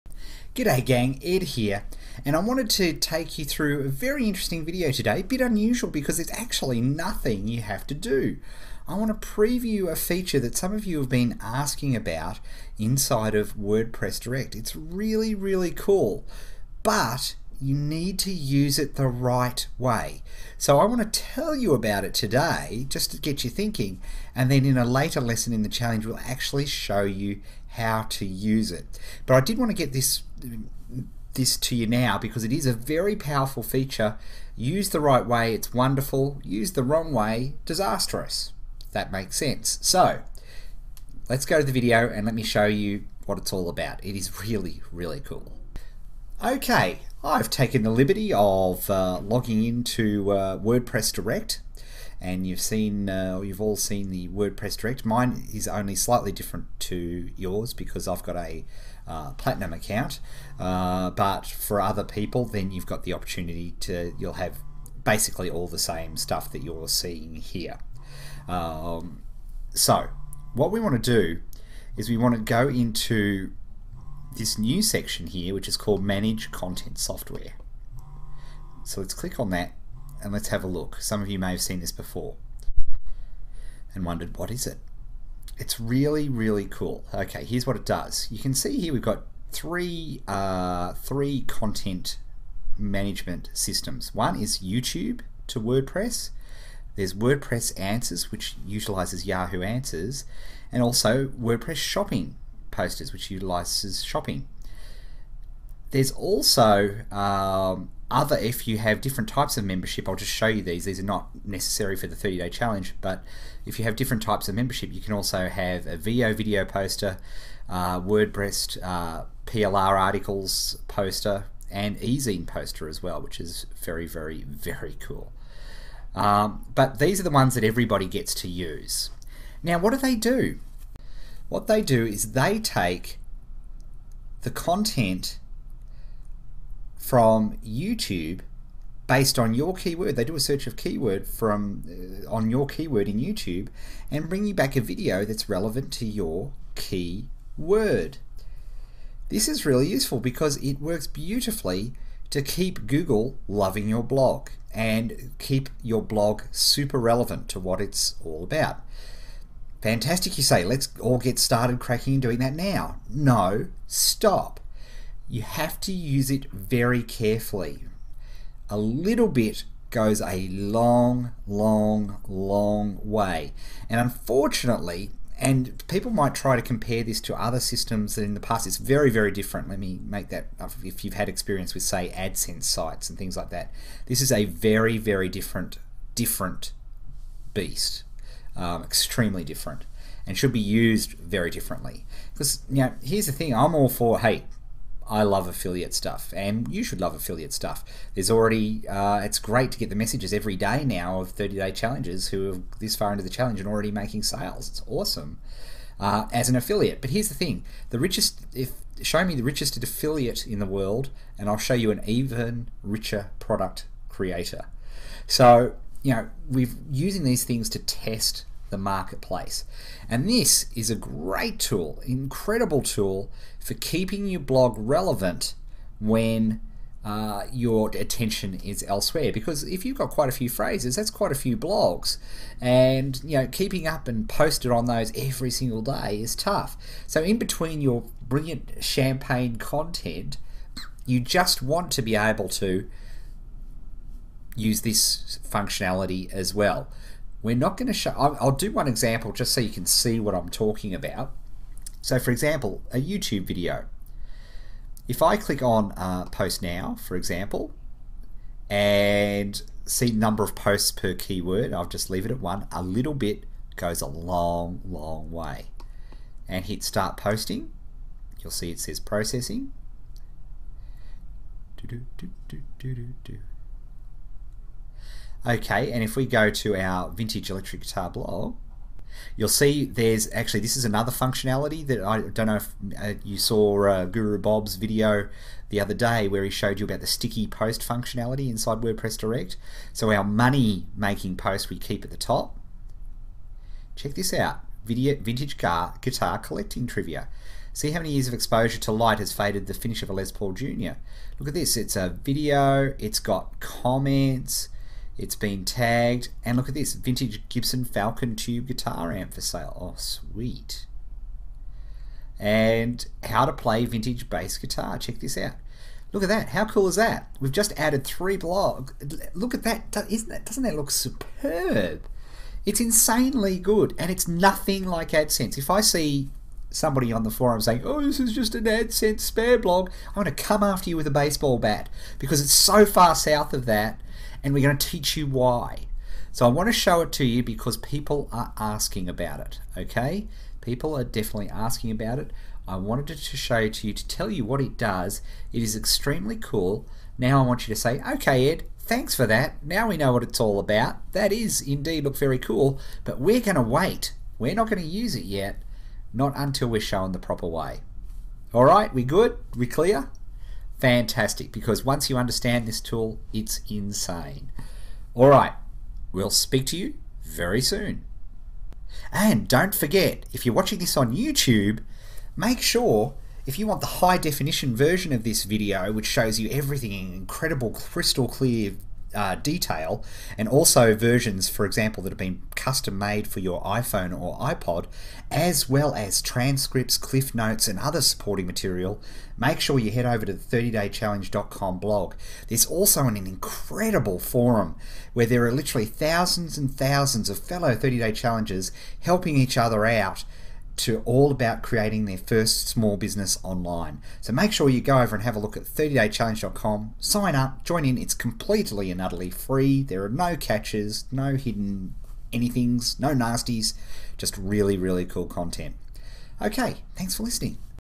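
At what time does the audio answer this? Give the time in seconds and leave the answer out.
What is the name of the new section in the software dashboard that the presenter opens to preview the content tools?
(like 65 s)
76 s.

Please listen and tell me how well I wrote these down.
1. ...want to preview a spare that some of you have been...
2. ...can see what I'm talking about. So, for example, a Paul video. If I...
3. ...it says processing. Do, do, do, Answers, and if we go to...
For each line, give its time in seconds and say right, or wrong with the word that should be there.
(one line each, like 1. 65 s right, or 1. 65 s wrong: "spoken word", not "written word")
1. 8 s wrong: "feature", not "spare"
2. 249 s wrong: "YouTube", not "Paul"
3. 268 s wrong: "Okay", not "Answers".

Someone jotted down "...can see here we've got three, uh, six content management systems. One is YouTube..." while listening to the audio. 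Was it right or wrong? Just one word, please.
wrong.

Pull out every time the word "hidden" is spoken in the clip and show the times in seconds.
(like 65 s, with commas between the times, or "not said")
411 s.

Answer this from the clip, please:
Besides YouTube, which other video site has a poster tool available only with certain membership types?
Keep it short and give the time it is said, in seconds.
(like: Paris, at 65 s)
Veoh, at 115 s.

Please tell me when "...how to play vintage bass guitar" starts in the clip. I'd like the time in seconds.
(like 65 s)
313 s.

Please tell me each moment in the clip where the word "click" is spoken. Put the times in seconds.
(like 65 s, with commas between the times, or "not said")
79 s, 255 s.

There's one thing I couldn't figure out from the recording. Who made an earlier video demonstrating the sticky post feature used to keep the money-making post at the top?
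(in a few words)
Guru Bob.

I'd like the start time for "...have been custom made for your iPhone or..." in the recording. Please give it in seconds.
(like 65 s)
382 s.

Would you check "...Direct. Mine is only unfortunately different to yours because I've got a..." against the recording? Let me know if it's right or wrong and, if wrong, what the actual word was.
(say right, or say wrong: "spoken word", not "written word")
wrong: "slightly", not "unfortunately".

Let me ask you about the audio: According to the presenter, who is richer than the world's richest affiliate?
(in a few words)
product creator.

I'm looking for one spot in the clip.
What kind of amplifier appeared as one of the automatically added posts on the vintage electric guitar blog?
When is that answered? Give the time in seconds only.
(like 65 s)
306 s.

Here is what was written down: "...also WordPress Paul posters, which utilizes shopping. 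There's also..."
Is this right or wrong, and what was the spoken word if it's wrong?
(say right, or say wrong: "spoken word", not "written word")
wrong: "Shopping", not "Paul".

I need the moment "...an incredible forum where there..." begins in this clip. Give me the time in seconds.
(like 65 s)
393 s.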